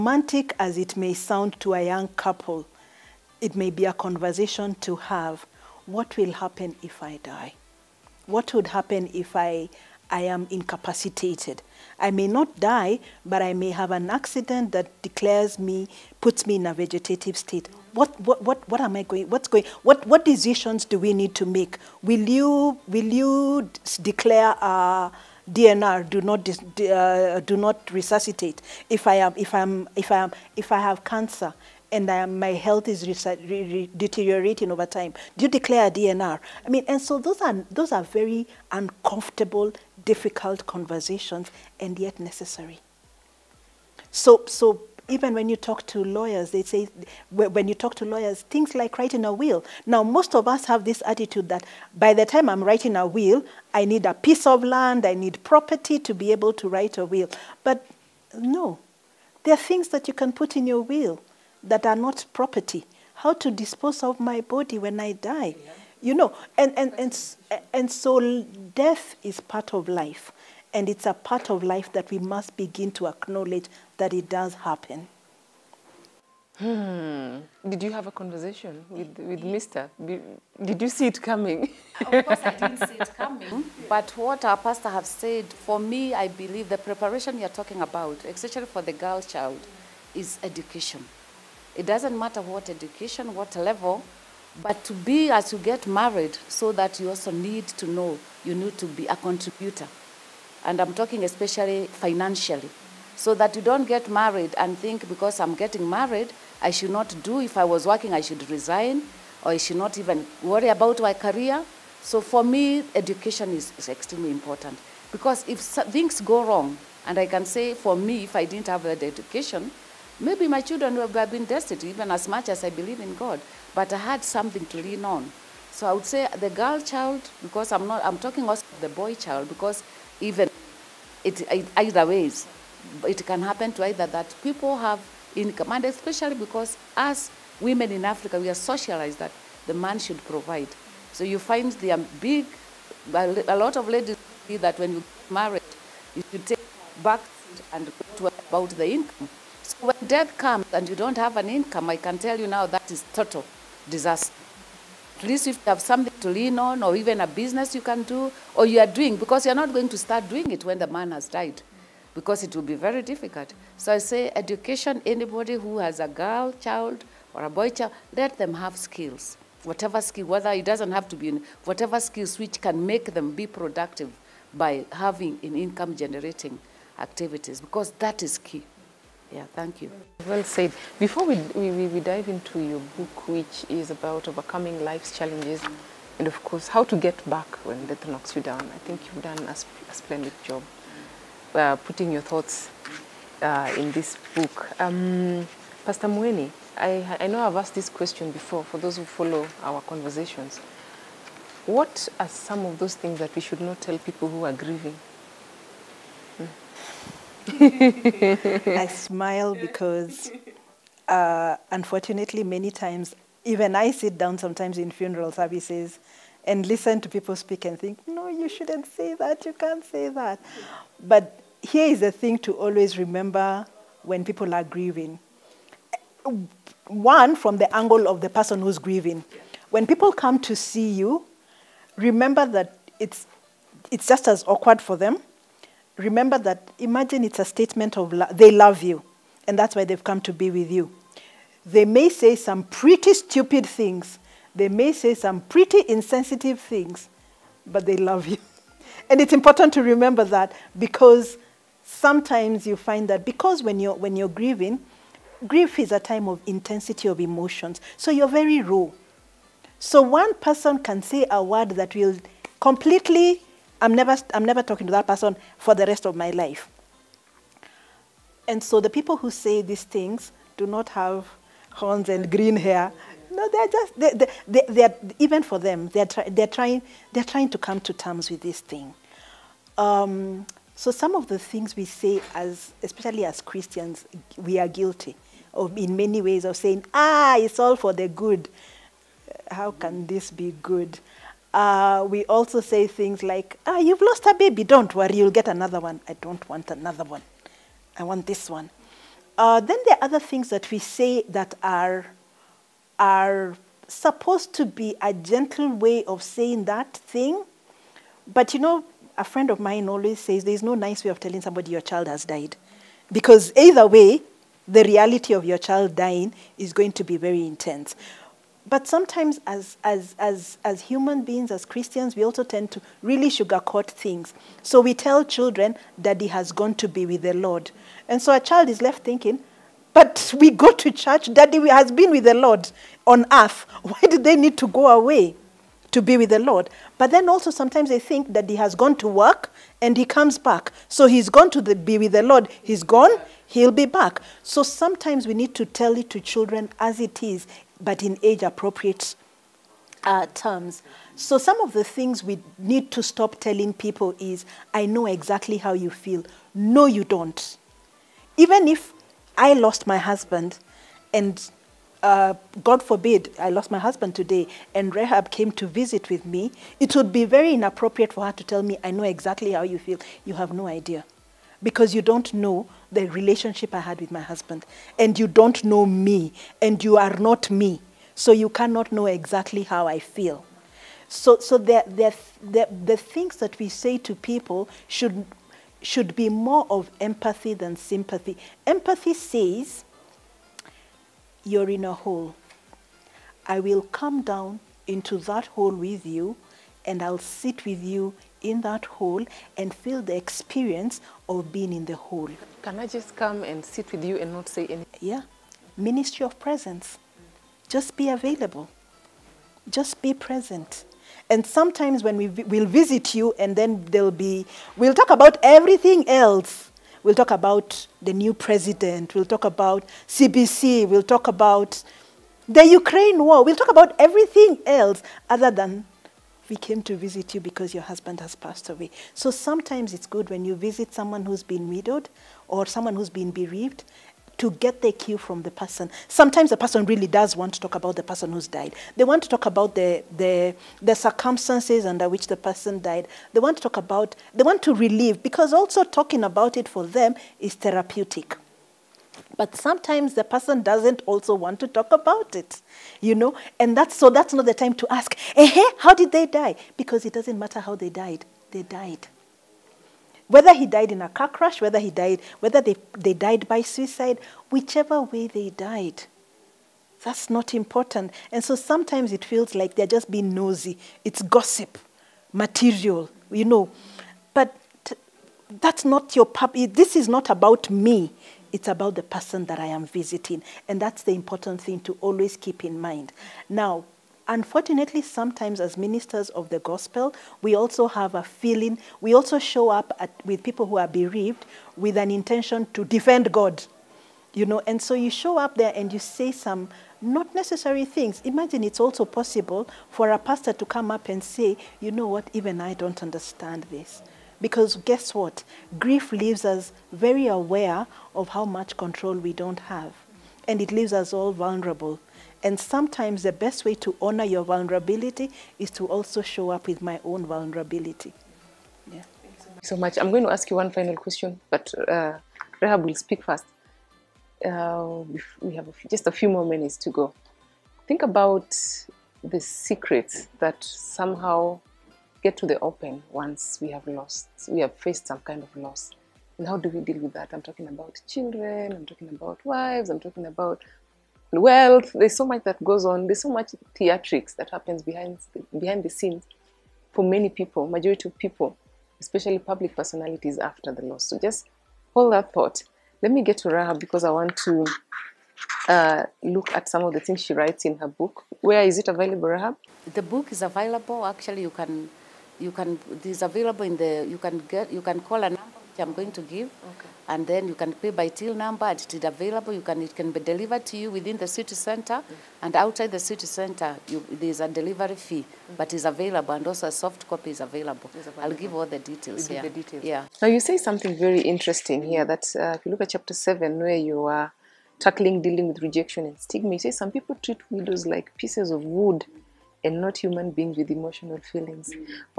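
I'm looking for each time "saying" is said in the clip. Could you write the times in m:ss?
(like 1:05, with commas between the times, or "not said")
4:46, 5:06.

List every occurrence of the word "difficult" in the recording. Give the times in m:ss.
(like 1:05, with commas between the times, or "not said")
0:40, 2:43.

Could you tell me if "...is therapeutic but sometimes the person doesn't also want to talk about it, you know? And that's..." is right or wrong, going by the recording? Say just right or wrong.
right.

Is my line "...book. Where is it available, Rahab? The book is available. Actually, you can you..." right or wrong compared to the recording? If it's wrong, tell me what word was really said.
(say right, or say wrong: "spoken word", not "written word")
right.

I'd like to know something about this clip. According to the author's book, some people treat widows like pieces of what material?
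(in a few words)
Wood.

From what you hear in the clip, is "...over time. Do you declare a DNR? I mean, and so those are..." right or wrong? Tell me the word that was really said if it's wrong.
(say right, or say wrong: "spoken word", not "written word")
right.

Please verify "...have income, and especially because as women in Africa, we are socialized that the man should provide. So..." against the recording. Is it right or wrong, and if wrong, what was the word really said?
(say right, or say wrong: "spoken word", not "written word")
right.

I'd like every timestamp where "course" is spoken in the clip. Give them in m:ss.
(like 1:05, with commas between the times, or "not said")
1:22, 3:06.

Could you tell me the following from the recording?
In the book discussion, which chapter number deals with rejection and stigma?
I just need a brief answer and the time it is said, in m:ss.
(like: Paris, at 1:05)
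7, at 9:43.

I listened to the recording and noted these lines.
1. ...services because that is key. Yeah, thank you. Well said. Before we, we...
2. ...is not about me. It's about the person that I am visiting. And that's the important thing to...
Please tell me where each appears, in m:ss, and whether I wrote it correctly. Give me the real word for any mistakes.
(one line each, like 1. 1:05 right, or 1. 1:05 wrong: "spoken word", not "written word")
1. 2:56 wrong: "activities", not "services"
2. 7:56 right.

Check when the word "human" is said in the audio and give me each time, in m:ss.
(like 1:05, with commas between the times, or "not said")
5:20, 9:49.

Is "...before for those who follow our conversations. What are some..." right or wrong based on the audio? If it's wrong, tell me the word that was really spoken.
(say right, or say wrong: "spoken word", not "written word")
right.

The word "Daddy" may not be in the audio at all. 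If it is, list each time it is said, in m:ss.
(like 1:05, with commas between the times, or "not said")
5:26, 5:31.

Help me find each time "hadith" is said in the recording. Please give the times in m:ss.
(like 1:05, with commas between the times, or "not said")
not said.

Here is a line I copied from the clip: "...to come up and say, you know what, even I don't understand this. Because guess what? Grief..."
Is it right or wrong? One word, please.
right.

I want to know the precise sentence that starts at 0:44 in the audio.
So, so even when you talk to lawyers, they say, when you talk to lawyers, things like writing a will.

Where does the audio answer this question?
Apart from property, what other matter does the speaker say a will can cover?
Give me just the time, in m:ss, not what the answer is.
1:03.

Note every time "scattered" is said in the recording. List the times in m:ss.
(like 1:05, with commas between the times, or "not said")
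not said.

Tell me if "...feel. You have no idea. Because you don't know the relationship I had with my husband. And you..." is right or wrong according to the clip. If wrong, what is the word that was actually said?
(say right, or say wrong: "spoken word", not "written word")
right.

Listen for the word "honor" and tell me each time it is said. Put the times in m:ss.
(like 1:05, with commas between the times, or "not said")
8:34.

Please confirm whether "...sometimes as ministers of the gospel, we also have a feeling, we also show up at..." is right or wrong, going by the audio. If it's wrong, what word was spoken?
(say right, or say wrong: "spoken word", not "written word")
right.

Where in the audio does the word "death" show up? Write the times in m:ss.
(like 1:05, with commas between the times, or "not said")
1:08, 2:30, 3:07.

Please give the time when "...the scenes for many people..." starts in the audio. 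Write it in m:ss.
9:05.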